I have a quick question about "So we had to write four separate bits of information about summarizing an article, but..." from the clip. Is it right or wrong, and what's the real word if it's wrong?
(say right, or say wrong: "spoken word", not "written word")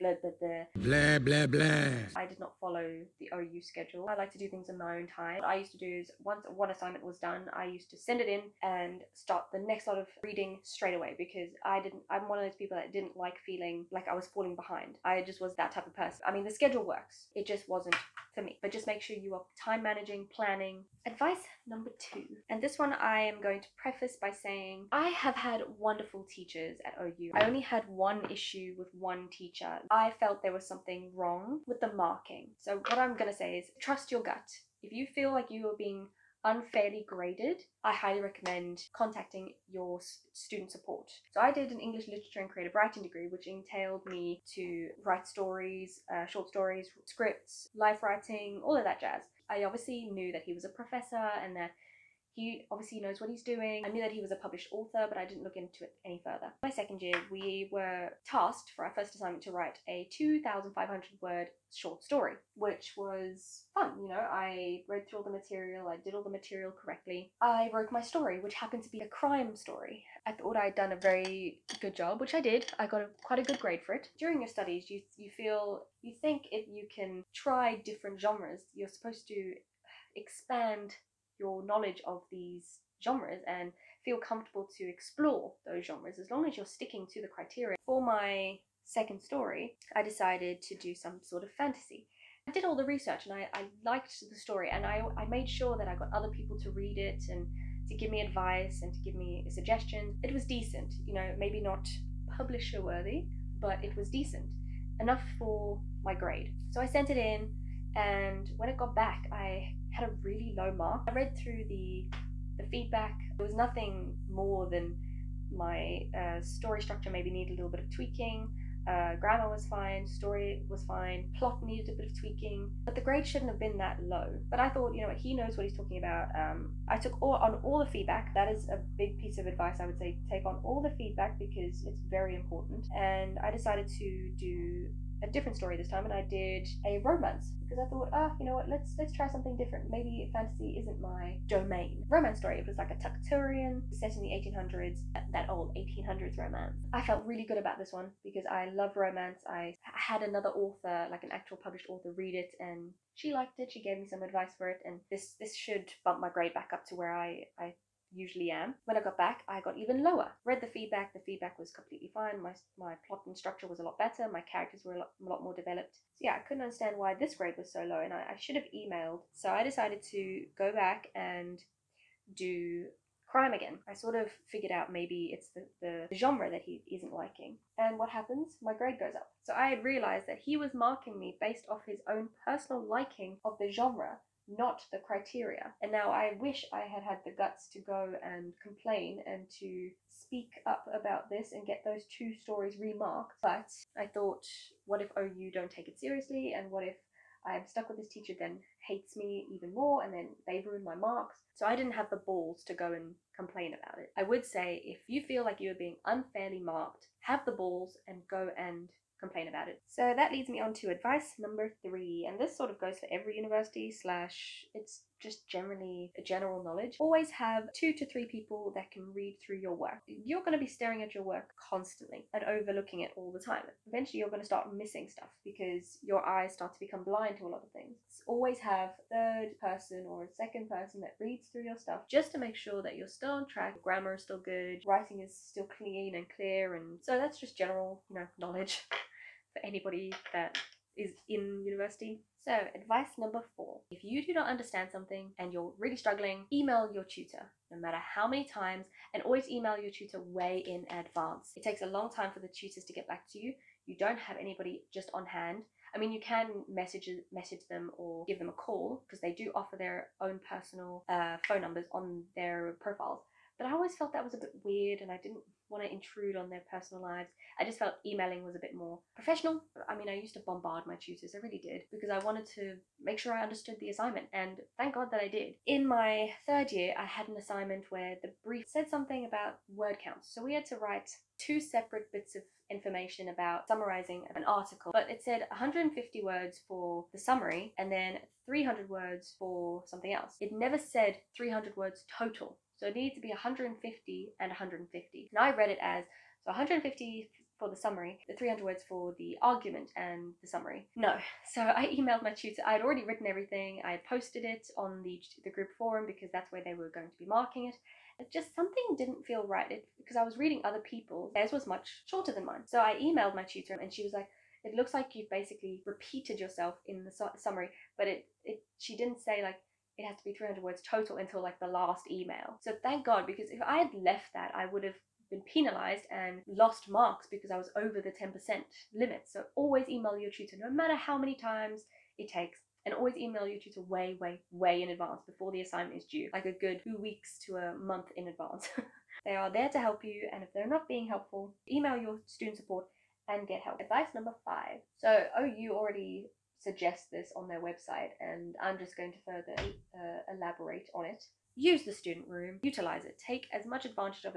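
wrong: "two", not "four".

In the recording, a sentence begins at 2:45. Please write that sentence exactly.
So yeah, I couldn't understand why this grade was so low, and I, I should have emailed.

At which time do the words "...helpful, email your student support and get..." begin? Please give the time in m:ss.
5:41.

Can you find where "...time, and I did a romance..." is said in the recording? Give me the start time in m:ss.
2:15.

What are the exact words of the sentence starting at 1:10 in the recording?
I thought I'd done a very good job, which I did.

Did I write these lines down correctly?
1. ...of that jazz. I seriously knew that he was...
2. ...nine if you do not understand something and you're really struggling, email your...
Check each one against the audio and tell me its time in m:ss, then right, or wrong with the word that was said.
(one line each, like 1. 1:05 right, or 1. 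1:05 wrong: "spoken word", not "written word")
1. 0:48 wrong: "obviously", not "seriously"
2. 4:03 wrong: "four", not "nine".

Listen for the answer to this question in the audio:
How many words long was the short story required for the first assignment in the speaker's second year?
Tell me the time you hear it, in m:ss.
1:00.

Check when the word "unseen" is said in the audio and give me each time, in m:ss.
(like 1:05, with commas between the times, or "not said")
not said.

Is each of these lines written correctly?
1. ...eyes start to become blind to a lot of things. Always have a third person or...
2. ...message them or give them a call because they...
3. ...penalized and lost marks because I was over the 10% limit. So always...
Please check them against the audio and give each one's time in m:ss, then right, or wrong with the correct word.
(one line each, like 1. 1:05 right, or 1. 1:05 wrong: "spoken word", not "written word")
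1. 3:46 right
2. 4:17 right
3. 5:25 right.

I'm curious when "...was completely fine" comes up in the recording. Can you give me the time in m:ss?
2:41.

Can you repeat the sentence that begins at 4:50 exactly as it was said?
It never said 300 words total.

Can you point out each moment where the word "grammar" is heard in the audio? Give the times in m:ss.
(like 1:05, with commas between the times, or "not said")
1:59, 3:53.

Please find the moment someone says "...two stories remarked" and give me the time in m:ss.
3:12.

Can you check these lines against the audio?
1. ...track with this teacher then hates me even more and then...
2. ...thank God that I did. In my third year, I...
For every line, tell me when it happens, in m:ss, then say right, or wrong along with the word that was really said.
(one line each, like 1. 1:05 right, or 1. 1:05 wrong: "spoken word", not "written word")
1. 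3:17 wrong: "stuck", not "track"
2. 4:34 right.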